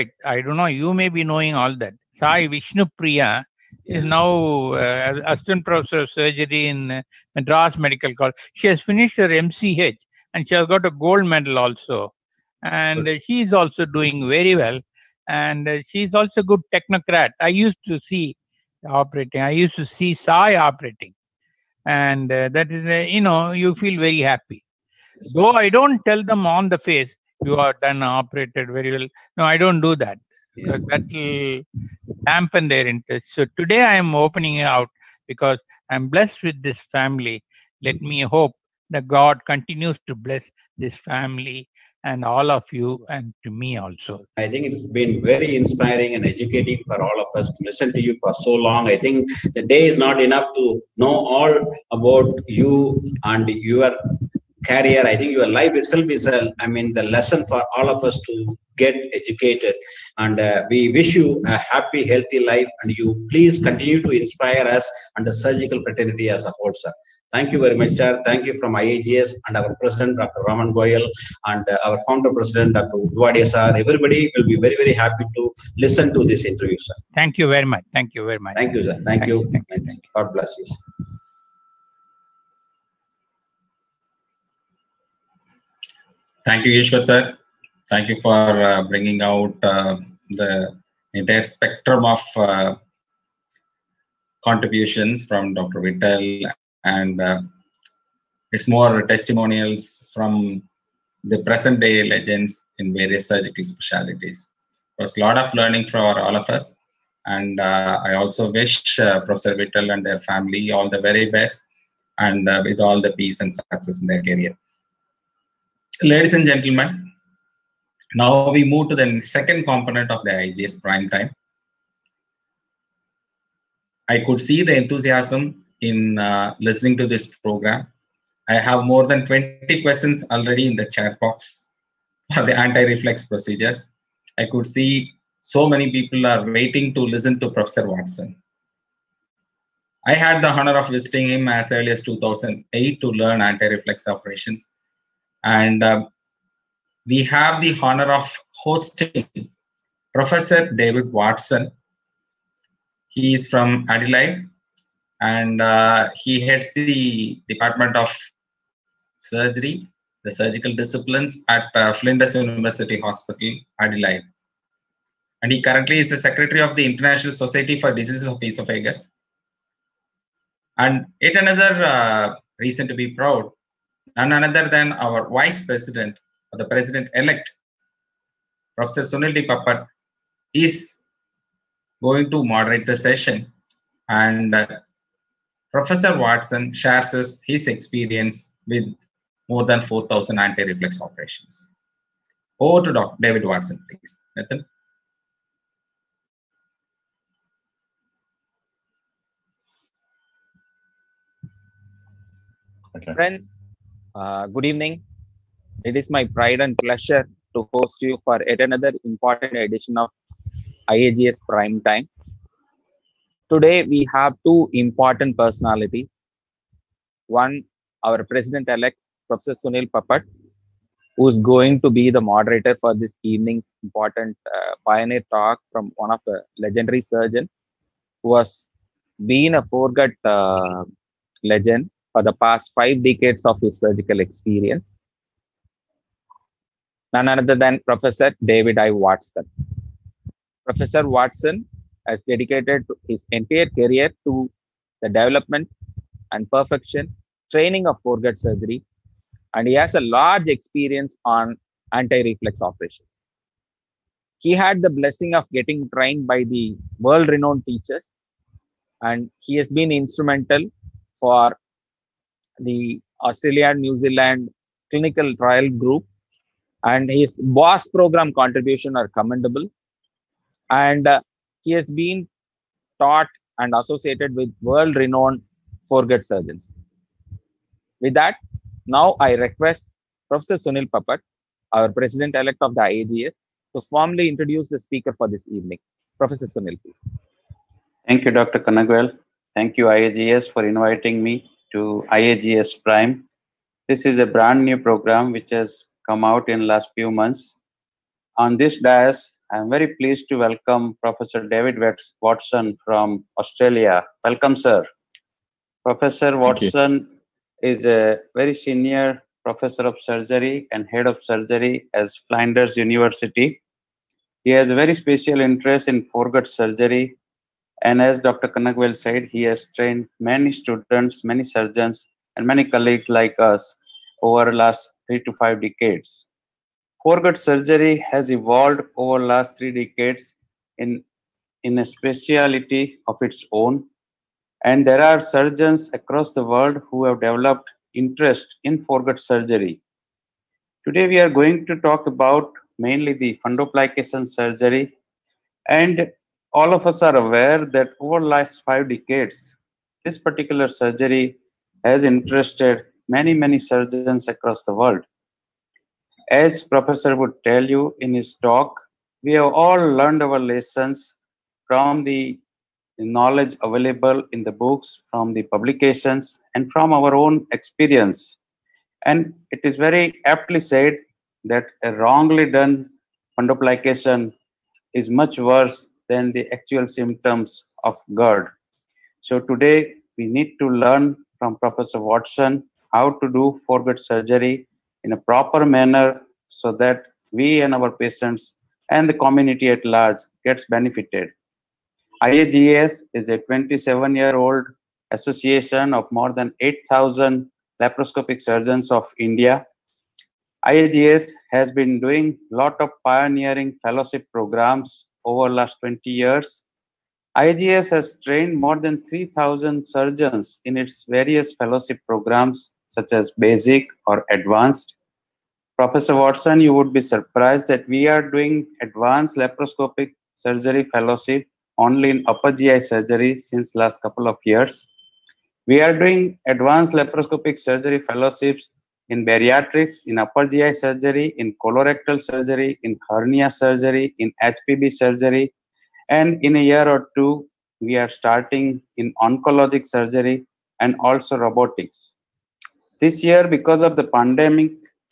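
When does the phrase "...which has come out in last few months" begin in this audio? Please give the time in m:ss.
4:55.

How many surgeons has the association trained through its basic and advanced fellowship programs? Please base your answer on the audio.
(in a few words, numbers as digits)
3,000.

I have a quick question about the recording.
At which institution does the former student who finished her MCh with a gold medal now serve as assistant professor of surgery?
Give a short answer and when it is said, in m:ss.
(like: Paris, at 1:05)
Madras Medical College, at 0:07.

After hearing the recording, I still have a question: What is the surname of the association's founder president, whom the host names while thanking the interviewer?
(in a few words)
Udwadia.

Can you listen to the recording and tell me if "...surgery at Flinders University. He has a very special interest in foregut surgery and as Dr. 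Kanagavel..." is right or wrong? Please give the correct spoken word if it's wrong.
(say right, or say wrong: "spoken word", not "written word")
right.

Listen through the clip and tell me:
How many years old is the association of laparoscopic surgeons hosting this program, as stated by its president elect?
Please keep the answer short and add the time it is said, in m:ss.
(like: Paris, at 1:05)
27, at 6:33.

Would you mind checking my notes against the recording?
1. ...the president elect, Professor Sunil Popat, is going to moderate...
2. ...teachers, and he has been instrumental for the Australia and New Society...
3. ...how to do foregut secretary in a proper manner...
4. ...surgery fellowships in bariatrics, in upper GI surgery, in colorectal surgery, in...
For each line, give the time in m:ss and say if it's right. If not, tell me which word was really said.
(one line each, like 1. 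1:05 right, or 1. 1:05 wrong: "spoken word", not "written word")
1. 2:56 right
2. 4:17 wrong: "Zealand", not "Society"
3. 6:22 wrong: "surgery", not "secretary"
4. 7:07 right.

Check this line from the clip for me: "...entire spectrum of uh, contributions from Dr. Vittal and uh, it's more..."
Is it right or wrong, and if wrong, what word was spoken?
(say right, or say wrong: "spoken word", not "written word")
right.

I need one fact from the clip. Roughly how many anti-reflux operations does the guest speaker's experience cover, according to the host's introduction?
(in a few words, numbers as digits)
4,000.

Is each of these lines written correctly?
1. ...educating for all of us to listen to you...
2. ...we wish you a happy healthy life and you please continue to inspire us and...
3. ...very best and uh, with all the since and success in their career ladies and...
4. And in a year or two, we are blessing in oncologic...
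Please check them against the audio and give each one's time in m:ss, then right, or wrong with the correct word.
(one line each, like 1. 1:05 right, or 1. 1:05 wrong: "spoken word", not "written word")
1. 0:46 right
2. 1:00 right
3. 1:51 wrong: "peace", not "since"
4. 7:16 wrong: "starting", not "blessing".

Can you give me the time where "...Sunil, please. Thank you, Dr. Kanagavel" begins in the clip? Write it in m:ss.
4:46.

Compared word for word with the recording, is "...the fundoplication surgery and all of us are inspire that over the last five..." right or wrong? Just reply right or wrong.
wrong.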